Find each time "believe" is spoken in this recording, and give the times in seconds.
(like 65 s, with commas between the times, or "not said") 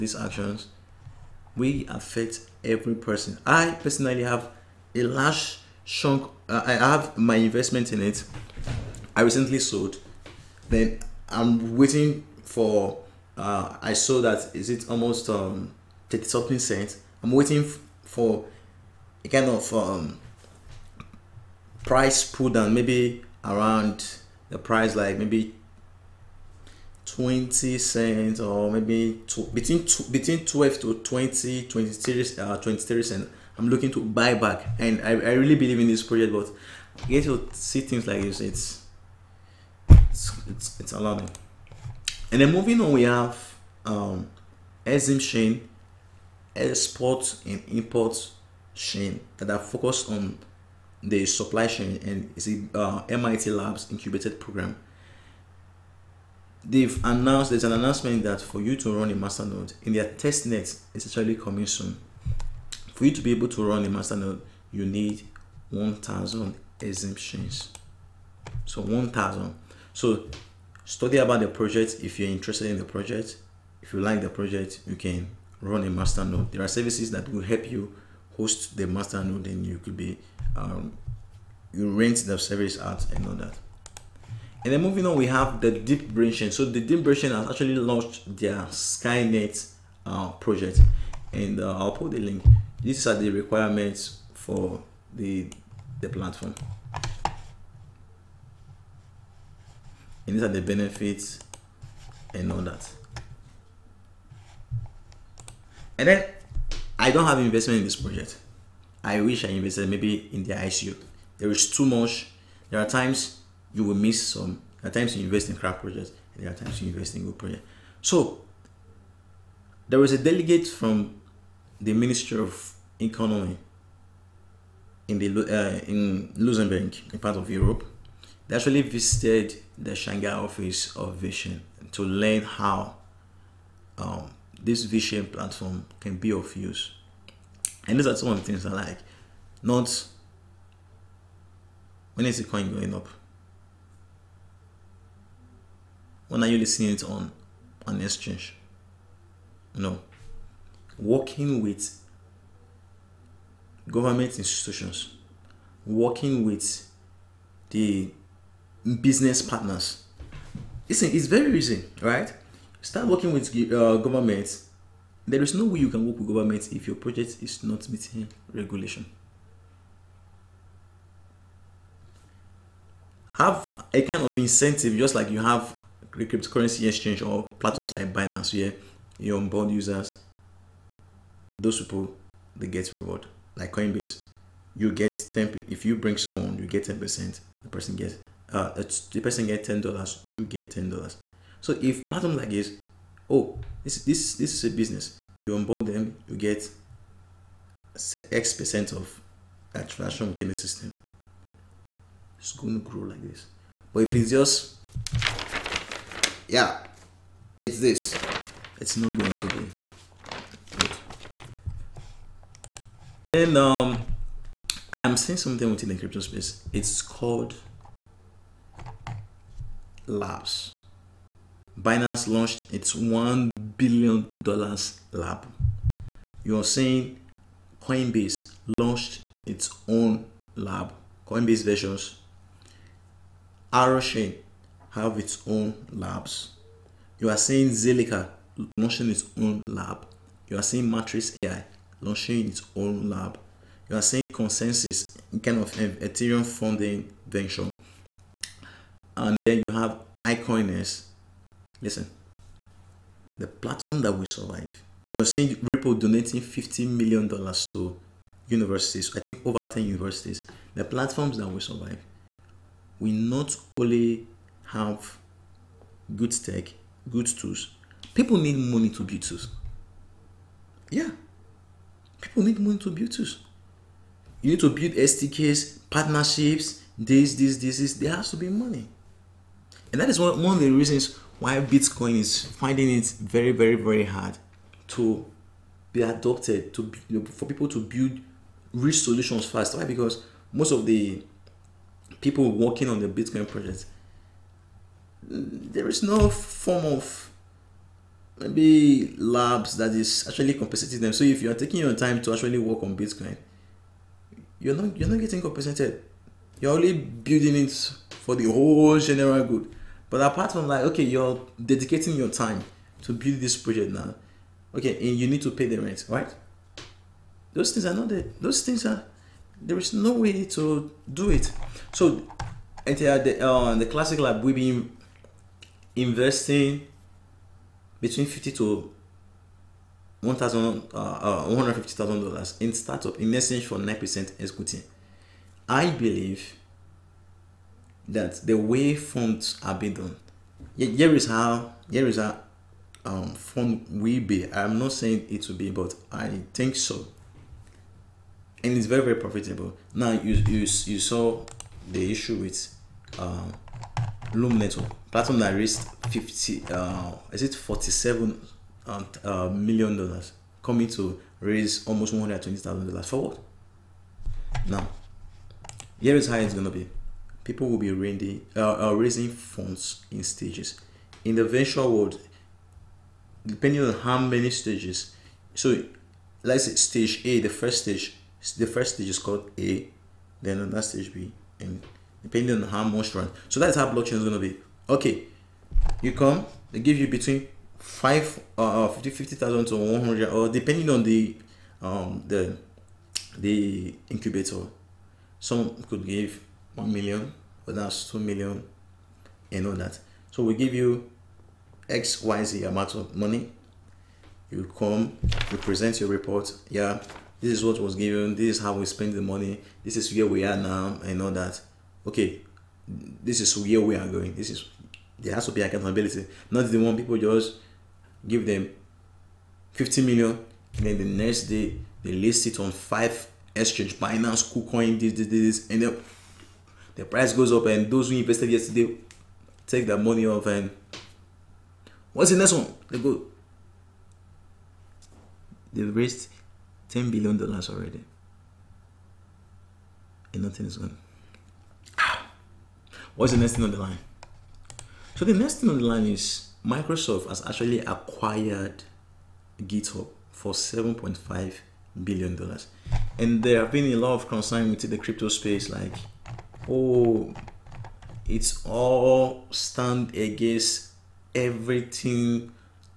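35 s, 335 s.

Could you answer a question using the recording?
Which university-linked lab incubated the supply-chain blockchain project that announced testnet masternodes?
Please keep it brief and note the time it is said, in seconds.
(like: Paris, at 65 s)
MIT Labs, at 53 s.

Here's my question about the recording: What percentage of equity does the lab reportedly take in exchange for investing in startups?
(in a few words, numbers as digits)
9%.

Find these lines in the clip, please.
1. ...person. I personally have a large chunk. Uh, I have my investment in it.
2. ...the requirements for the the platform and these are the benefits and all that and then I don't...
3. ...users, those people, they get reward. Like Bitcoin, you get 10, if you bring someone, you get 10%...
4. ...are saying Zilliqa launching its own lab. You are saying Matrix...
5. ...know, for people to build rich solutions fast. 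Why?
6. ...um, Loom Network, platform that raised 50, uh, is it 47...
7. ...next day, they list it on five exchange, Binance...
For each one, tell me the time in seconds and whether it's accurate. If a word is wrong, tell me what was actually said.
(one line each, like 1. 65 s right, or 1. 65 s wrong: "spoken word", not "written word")
1. 2 s right
2. 93 s right
3. 179 s wrong: "Coinbase", not "Bitcoin"
4. 237 s right
5. 287 s right
6. 353 s right
7. 421 s right.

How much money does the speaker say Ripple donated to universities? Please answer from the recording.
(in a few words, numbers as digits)
$15 million.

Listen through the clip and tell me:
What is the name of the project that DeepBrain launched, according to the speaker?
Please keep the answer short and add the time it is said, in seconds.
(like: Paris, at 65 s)
Skynet, at 88 s.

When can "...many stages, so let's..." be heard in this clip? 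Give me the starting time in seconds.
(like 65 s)
374 s.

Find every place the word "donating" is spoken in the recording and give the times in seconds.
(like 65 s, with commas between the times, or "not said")
255 s.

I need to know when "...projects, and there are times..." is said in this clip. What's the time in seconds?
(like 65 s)
115 s.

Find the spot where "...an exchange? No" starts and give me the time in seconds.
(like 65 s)
147 s.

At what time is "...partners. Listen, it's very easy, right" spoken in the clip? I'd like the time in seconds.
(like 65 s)
159 s.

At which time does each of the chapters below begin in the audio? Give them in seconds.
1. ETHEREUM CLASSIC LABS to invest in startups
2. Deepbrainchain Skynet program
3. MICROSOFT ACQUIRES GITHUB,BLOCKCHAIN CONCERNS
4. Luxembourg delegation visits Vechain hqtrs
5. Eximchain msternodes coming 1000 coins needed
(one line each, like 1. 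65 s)
1. 212 s
2. 83 s
3. 446 s
4. 112 s
5. 41 s.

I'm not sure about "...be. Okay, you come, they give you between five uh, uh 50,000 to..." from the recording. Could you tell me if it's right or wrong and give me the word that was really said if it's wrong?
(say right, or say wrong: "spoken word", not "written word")
right.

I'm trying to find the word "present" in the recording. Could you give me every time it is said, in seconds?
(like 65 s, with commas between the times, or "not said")
405 s.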